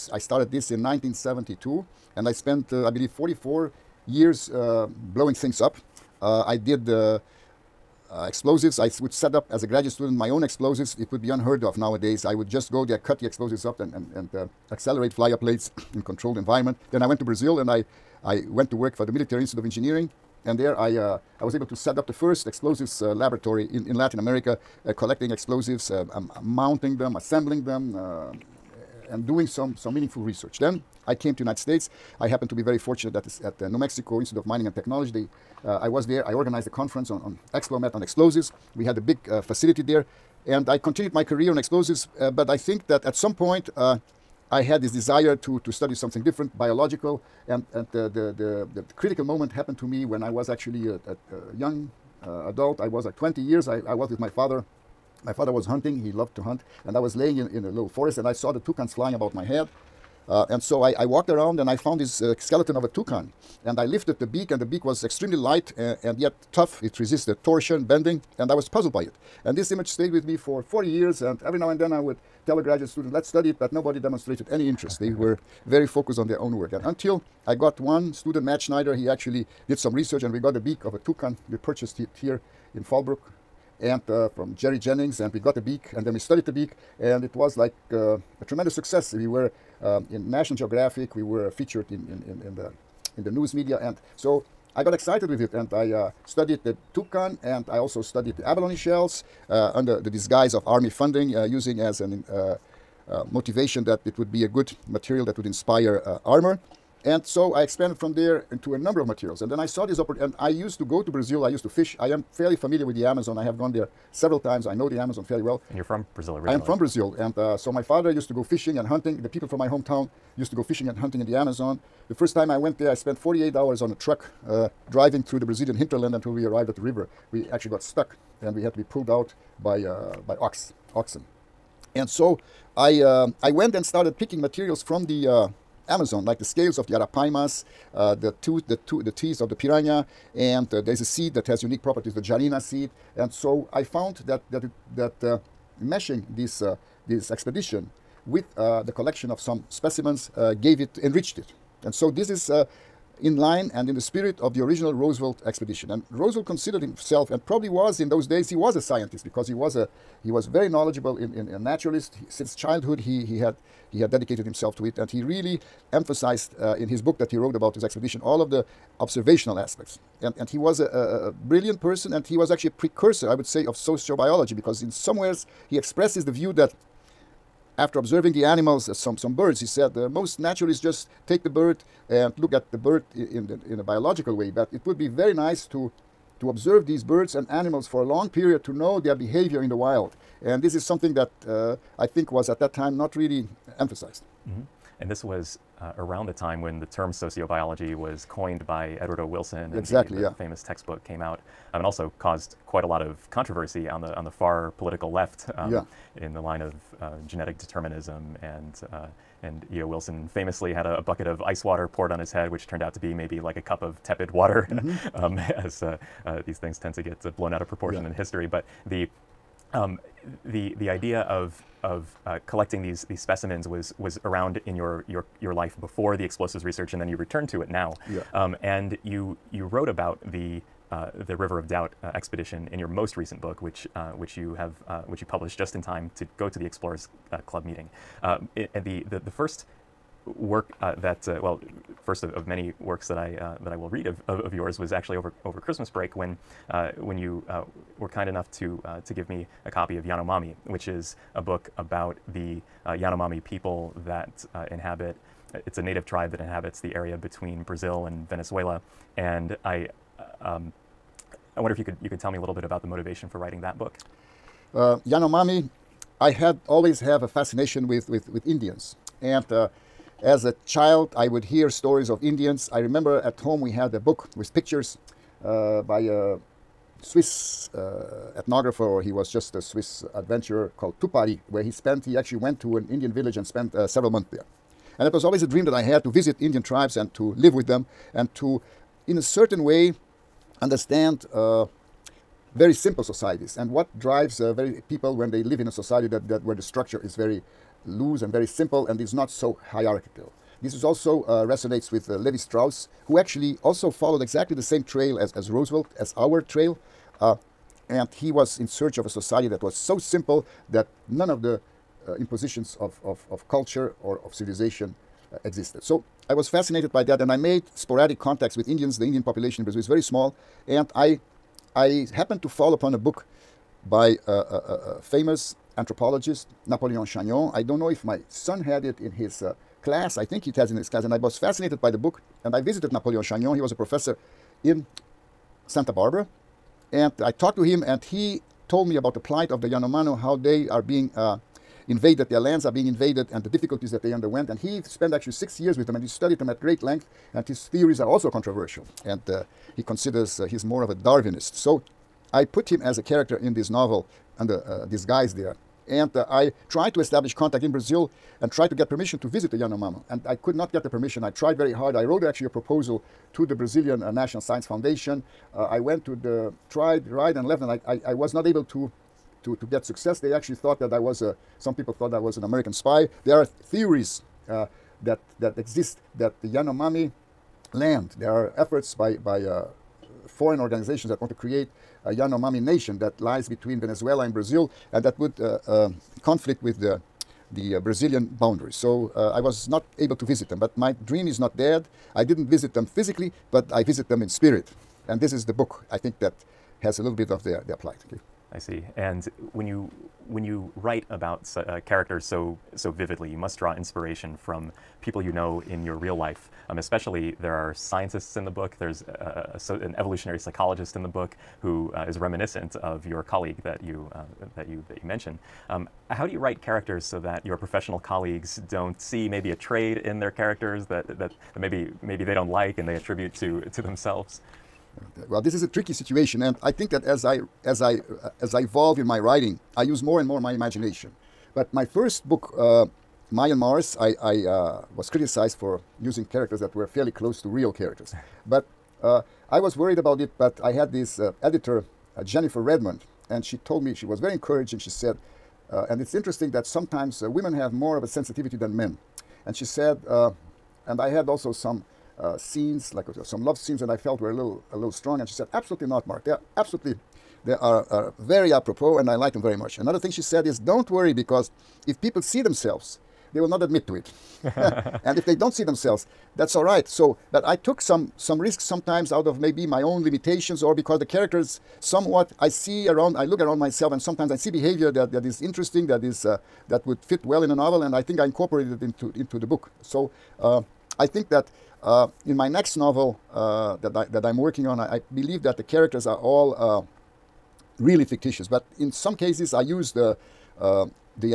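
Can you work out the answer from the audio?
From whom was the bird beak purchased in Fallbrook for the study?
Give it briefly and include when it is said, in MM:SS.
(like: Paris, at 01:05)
Jerry Jennings, at 01:24.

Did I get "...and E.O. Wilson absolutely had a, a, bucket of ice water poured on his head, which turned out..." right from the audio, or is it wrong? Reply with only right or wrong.
wrong.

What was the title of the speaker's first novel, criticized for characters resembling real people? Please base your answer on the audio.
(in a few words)
Mayan Mars.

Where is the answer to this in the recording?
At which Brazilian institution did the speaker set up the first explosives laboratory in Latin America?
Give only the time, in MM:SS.
00:19.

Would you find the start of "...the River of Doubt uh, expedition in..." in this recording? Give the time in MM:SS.
03:51.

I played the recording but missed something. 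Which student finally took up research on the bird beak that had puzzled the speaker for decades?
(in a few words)
Matt Schneider.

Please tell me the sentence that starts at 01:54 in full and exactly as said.
I know the Amazon fairly well.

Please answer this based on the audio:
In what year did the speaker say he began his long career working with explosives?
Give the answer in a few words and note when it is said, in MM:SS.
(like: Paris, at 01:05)
1972, at 00:00.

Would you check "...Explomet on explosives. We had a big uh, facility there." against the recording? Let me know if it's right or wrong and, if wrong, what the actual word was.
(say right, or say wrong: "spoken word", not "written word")
right.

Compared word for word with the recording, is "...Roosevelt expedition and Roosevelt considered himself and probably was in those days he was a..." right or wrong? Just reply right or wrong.
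right.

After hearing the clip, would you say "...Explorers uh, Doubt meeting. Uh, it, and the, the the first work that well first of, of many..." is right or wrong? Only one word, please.
wrong.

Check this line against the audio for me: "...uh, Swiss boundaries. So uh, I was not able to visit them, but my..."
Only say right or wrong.
wrong.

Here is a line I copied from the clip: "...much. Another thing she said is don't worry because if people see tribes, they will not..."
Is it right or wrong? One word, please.
wrong.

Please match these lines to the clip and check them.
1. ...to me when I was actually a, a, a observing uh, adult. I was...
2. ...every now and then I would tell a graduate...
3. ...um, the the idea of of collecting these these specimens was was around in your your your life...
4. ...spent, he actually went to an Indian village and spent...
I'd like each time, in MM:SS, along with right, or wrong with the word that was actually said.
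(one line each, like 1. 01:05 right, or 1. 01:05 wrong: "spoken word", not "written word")
1. 00:49 wrong: "young", not "observing"
2. 01:11 right
3. 03:39 right
4. 04:41 right.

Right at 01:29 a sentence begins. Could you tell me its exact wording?
We were um, in National Geographic, we were featured in, in, in, in, the, in the news media.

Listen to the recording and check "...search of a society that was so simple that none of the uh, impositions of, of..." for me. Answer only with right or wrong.
right.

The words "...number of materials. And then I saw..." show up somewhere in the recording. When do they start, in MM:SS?
01:48.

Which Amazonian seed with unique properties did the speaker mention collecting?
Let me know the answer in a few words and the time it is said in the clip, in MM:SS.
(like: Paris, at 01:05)
jarina seed, at 02:22.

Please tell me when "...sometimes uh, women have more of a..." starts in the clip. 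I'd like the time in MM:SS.
07:26.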